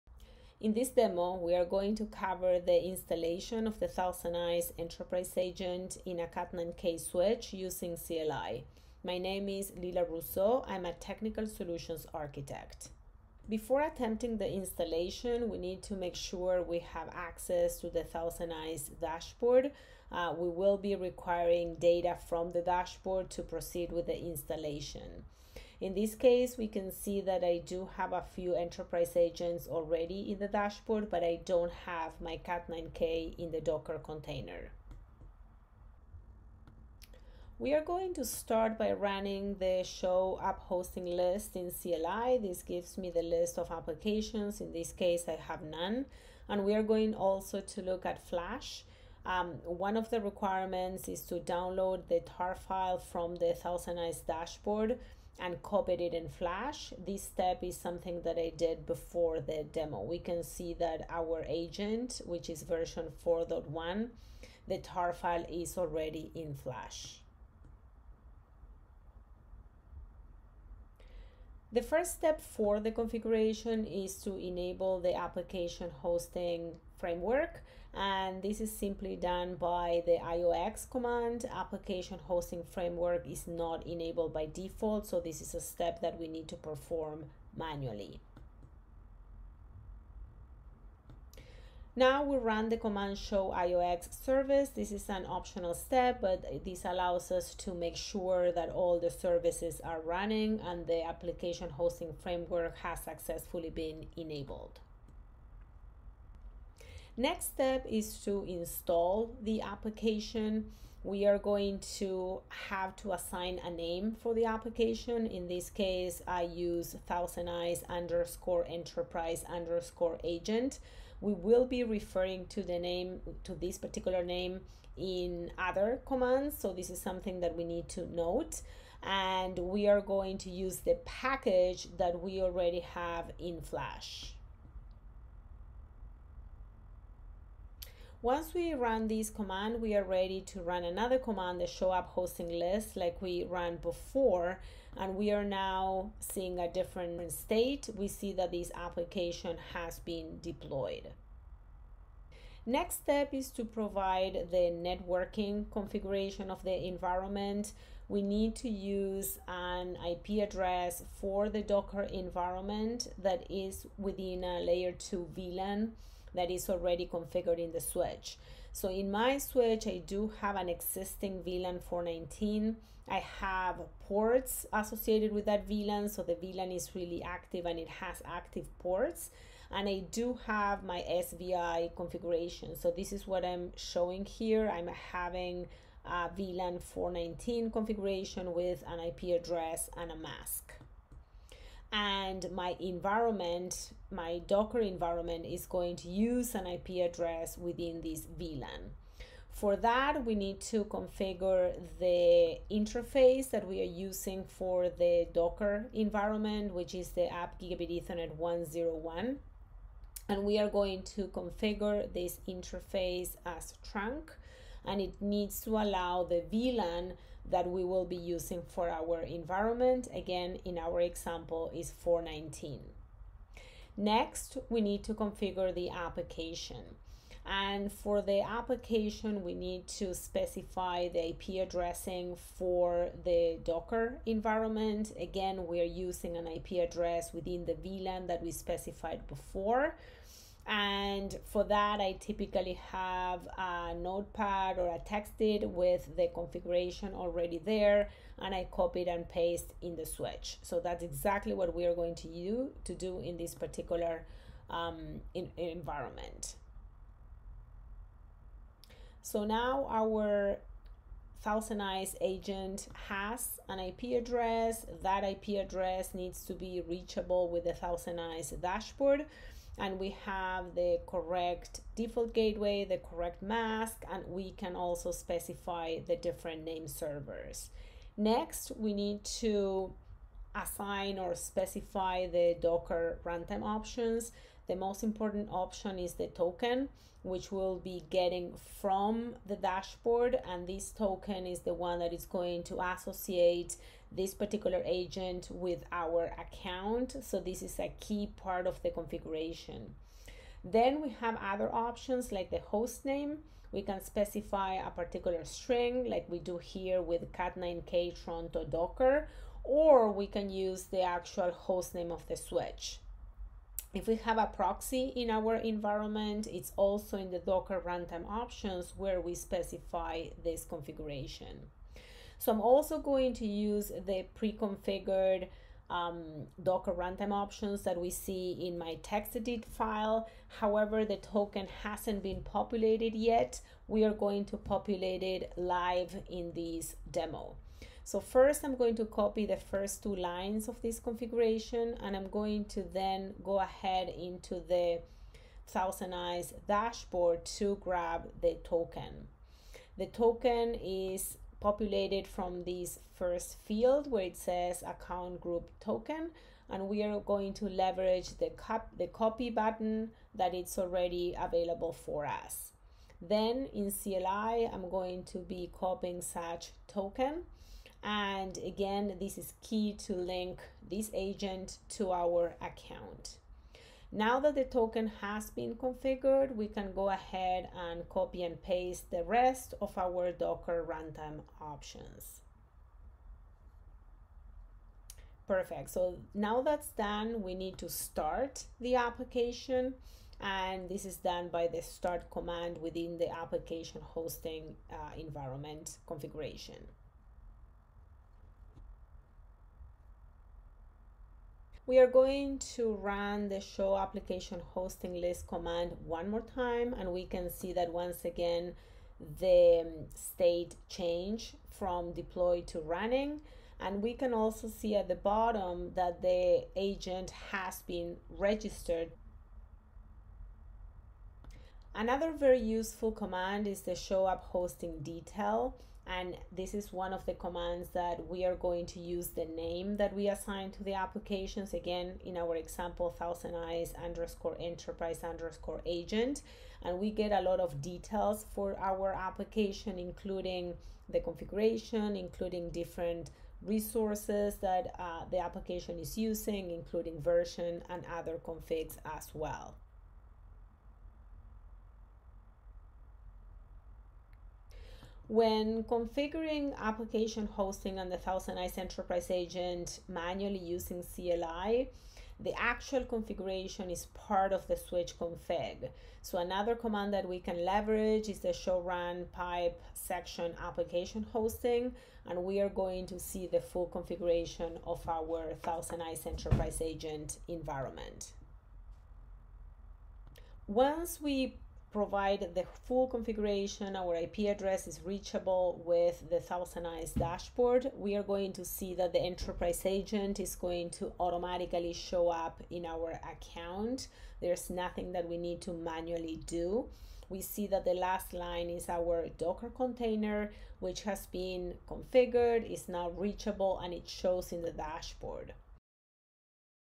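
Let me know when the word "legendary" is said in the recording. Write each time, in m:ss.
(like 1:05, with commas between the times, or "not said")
not said.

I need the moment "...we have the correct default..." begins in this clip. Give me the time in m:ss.
4:29.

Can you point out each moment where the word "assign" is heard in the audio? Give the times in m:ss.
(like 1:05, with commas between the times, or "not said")
1:53, 4:40, 7:10.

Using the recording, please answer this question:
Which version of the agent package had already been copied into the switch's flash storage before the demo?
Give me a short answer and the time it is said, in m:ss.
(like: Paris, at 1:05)
4.1, at 1:03.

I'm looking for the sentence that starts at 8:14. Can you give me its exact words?
There's nothing that we need to manually do.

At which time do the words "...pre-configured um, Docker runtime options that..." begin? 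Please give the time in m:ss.
5:24.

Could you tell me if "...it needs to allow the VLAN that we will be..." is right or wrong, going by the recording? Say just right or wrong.
right.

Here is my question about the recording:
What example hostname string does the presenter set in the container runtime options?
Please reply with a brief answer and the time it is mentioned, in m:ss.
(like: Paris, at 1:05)
cat9k Toronto Docker, at 5:07.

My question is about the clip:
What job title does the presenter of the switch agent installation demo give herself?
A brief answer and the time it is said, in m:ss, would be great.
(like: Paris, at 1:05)
technical solutions architect, at 0:10.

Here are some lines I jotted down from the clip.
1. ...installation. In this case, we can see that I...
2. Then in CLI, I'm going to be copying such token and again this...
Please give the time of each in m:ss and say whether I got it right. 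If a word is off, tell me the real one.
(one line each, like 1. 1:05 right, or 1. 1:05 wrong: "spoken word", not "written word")
1. 0:24 right
2. 6:03 right.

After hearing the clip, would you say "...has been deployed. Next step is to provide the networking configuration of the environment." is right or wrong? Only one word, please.
right.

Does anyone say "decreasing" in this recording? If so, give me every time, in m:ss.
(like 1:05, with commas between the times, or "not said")
not said.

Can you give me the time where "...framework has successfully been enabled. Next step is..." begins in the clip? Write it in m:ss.
1:42.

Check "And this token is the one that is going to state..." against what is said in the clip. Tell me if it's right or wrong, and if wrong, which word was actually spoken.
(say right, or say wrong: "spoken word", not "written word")
wrong: "associate", not "state".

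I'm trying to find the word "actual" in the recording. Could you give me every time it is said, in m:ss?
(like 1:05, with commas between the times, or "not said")
5:11, 7:42.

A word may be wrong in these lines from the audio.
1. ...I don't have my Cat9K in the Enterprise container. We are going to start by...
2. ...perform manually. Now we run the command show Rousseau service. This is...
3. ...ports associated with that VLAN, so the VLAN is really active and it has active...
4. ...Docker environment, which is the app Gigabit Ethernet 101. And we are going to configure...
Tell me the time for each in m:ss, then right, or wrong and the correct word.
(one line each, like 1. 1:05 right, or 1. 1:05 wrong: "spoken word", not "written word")
1. 0:31 wrong: "Docker", not "Enterprise"
2. 1:26 wrong: "IOX", not "Rousseau"
3. 2:54 right
4. 3:25 right.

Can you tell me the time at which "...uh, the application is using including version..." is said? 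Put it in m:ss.
7:24.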